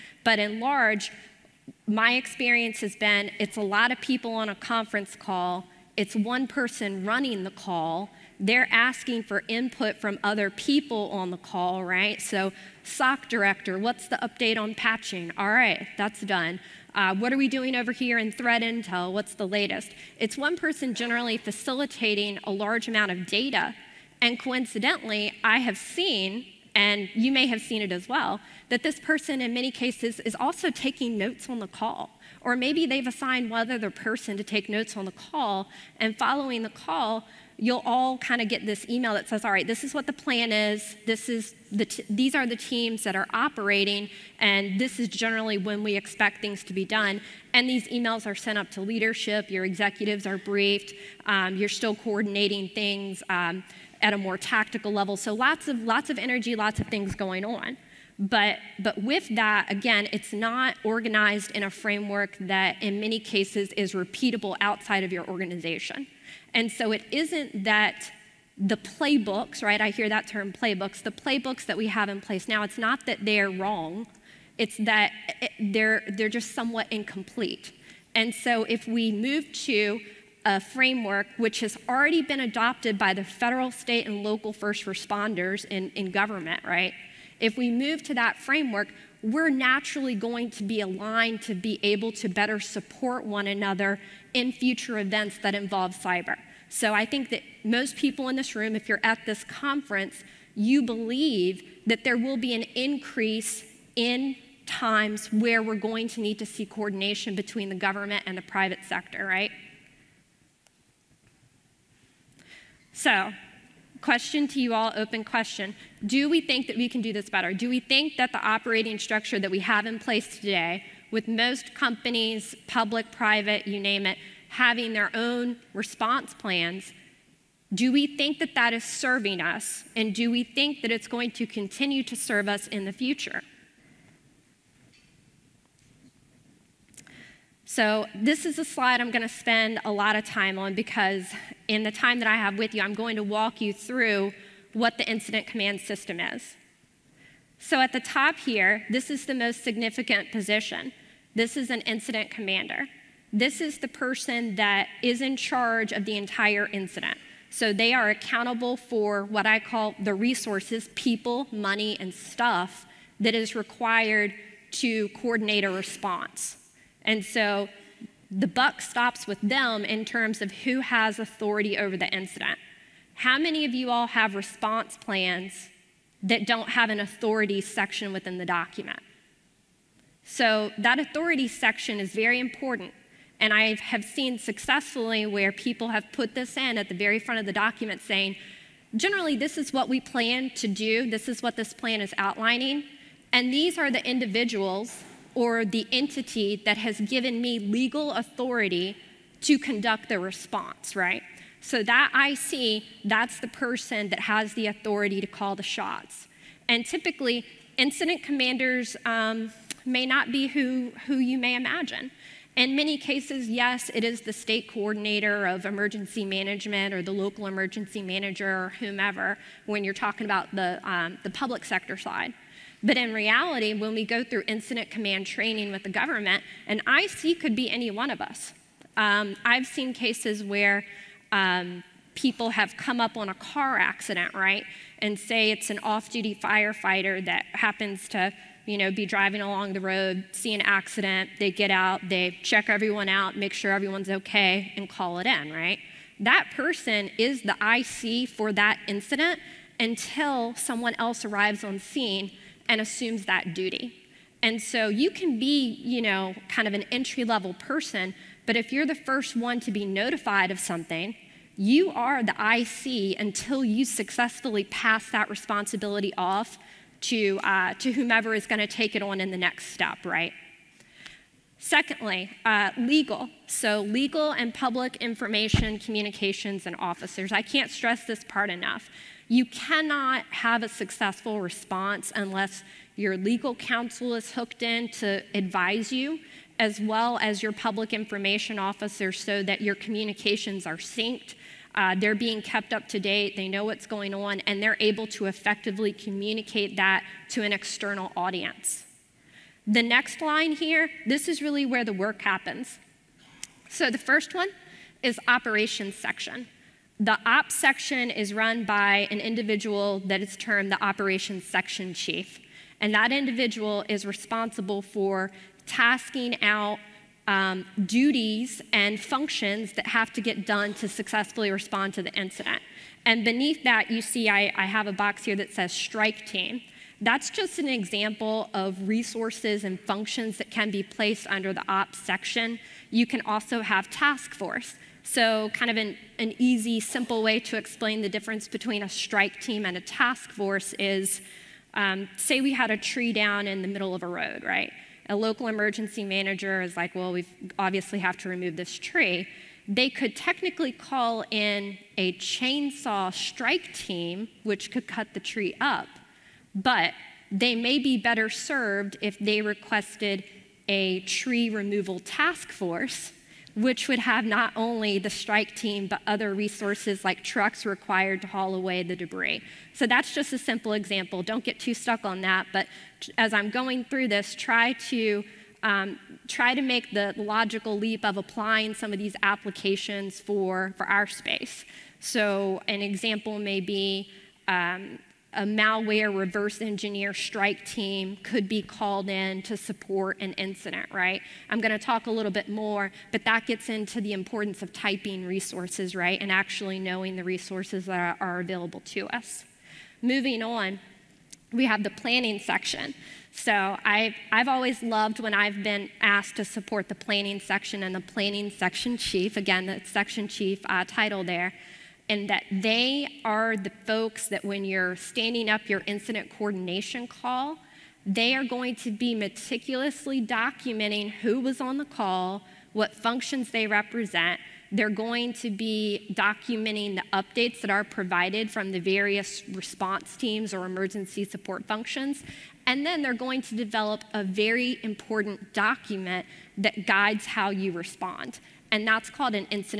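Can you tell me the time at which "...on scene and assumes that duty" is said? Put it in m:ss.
4:11.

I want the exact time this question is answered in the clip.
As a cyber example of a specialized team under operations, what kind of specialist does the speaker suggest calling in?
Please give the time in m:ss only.
6:25.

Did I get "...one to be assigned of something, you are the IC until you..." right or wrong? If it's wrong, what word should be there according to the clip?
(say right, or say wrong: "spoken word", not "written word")
wrong: "notified", not "assigned".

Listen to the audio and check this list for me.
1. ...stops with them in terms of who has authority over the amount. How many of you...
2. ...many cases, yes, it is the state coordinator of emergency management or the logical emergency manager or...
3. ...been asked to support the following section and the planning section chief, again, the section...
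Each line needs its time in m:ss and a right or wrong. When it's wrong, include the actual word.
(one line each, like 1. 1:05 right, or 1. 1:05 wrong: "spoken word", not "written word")
1. 2:48 wrong: "incident", not "amount"
2. 3:32 wrong: "local", not "logical"
3. 6:45 wrong: "planning", not "following".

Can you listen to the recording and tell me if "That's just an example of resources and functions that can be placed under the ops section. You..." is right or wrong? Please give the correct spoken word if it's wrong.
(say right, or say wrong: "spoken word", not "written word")
right.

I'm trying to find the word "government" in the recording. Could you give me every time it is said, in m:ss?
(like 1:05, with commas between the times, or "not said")
1:26, 1:47, 3:45.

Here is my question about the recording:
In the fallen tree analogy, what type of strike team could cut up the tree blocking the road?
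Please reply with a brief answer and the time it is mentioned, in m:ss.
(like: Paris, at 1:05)
chainsaw strike team, at 5:52.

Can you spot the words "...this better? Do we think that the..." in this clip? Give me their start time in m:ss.
1:57.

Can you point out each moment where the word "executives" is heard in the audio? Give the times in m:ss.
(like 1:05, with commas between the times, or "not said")
0:49.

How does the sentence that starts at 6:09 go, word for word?
So that's just a simple example.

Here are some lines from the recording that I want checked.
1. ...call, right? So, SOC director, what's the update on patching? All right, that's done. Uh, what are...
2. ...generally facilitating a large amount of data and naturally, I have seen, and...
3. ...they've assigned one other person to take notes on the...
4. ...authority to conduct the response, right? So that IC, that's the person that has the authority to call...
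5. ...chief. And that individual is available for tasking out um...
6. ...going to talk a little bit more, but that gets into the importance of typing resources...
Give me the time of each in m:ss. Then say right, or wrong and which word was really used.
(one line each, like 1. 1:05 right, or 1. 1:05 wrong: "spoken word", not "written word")
1. 0:11 right
2. 0:20 wrong: "coincidentally", not "naturally"
3. 0:32 right
4. 3:18 right
5. 5:11 wrong: "responsible", not "available"
6. 6:31 right.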